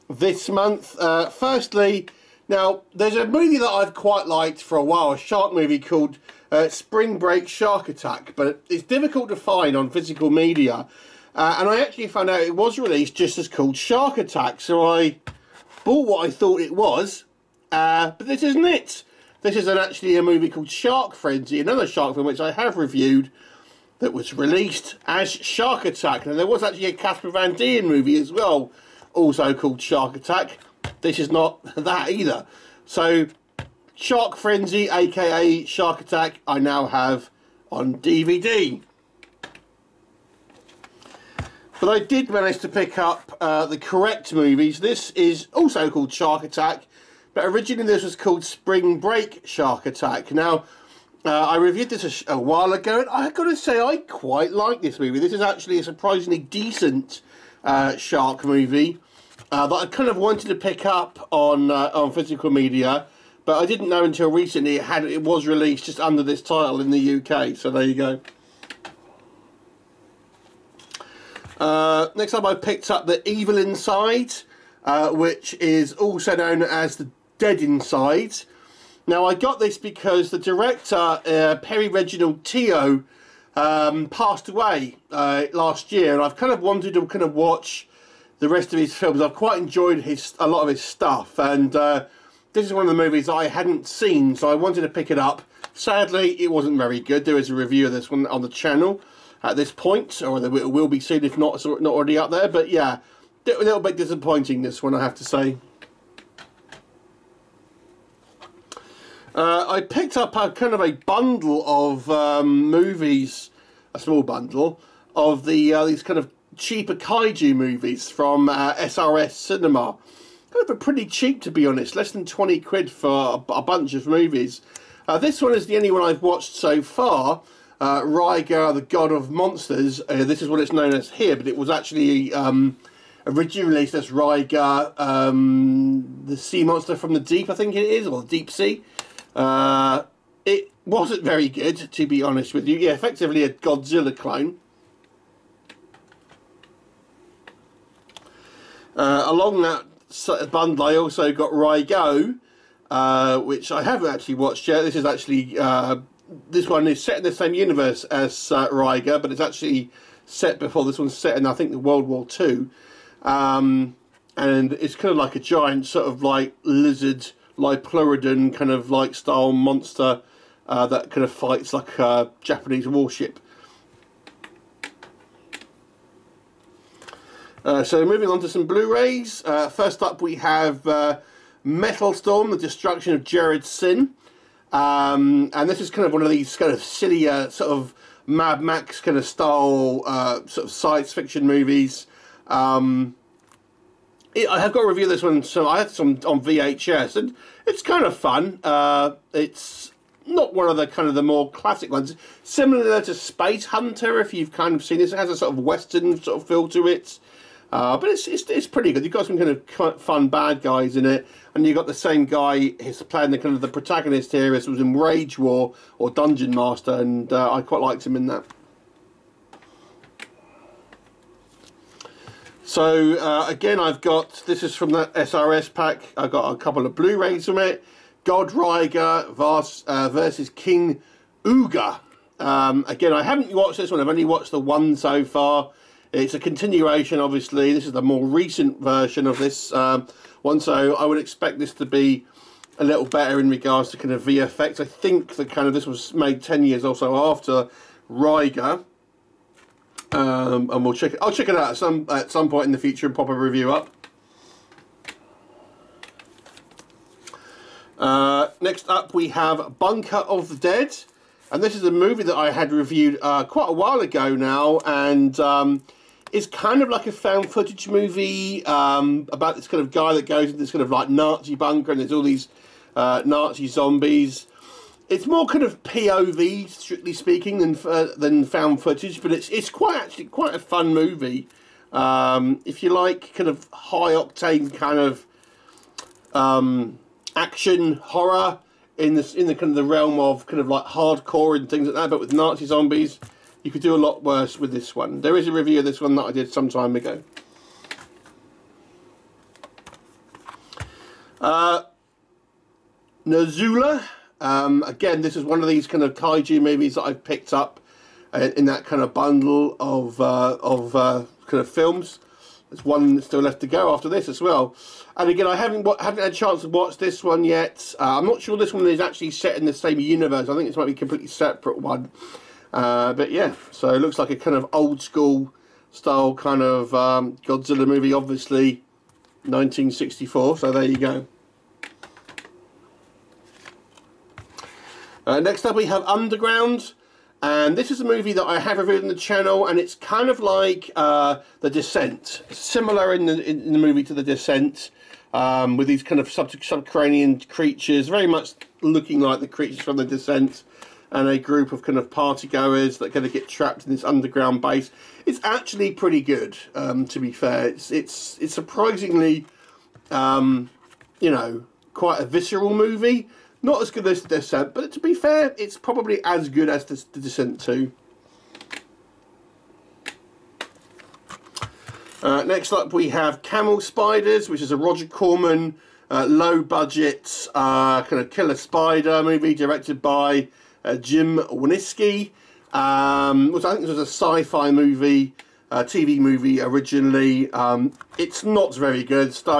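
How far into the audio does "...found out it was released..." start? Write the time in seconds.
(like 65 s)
12 s.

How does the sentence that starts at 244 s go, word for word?
I think that kind of this was made 10 years or so after Raiga, Um, and we'll check it.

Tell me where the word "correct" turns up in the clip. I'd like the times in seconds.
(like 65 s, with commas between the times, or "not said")
43 s.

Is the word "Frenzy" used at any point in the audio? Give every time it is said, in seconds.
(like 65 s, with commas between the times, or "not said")
21 s, 34 s.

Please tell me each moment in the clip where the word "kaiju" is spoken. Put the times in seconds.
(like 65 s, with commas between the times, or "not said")
116 s, 306 s.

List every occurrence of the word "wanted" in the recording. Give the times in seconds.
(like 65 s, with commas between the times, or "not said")
60 s, 86 s, 94 s.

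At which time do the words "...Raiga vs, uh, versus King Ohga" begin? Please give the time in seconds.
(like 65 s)
228 s.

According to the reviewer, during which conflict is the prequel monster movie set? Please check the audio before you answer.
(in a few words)
World War Two.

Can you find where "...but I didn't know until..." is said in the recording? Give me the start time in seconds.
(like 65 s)
63 s.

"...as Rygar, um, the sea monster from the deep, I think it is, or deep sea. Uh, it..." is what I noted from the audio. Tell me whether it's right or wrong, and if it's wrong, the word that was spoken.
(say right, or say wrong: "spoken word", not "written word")
right.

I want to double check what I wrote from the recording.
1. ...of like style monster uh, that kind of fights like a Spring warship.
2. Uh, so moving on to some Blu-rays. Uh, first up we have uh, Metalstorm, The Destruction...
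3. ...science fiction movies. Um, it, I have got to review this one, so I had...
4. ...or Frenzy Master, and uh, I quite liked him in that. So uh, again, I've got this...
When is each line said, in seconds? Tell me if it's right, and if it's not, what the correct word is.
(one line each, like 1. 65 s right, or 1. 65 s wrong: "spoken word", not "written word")
1. 168 s wrong: "Japanese", not "Spring"
2. 177 s right
3. 190 s right
4. 215 s wrong: "Dungeon", not "Frenzy".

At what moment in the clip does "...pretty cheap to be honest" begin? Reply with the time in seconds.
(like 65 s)
120 s.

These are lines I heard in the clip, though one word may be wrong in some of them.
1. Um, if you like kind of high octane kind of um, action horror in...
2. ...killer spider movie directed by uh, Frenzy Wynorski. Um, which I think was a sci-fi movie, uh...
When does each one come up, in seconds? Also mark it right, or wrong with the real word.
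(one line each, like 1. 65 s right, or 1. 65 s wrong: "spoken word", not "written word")
1. 281 s right
2. 378 s wrong: "Jim", not "Frenzy".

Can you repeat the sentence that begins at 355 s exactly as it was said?
It's actually pretty good, um, to be fair.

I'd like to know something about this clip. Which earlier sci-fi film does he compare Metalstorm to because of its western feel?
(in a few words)
Spacehunter.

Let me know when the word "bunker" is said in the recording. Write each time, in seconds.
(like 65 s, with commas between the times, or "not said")
259 s, 271 s.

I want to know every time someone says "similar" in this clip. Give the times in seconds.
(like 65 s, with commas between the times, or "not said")
202 s, 342 s.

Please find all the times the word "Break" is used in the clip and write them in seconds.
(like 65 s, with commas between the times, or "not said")
7 s, 48 s.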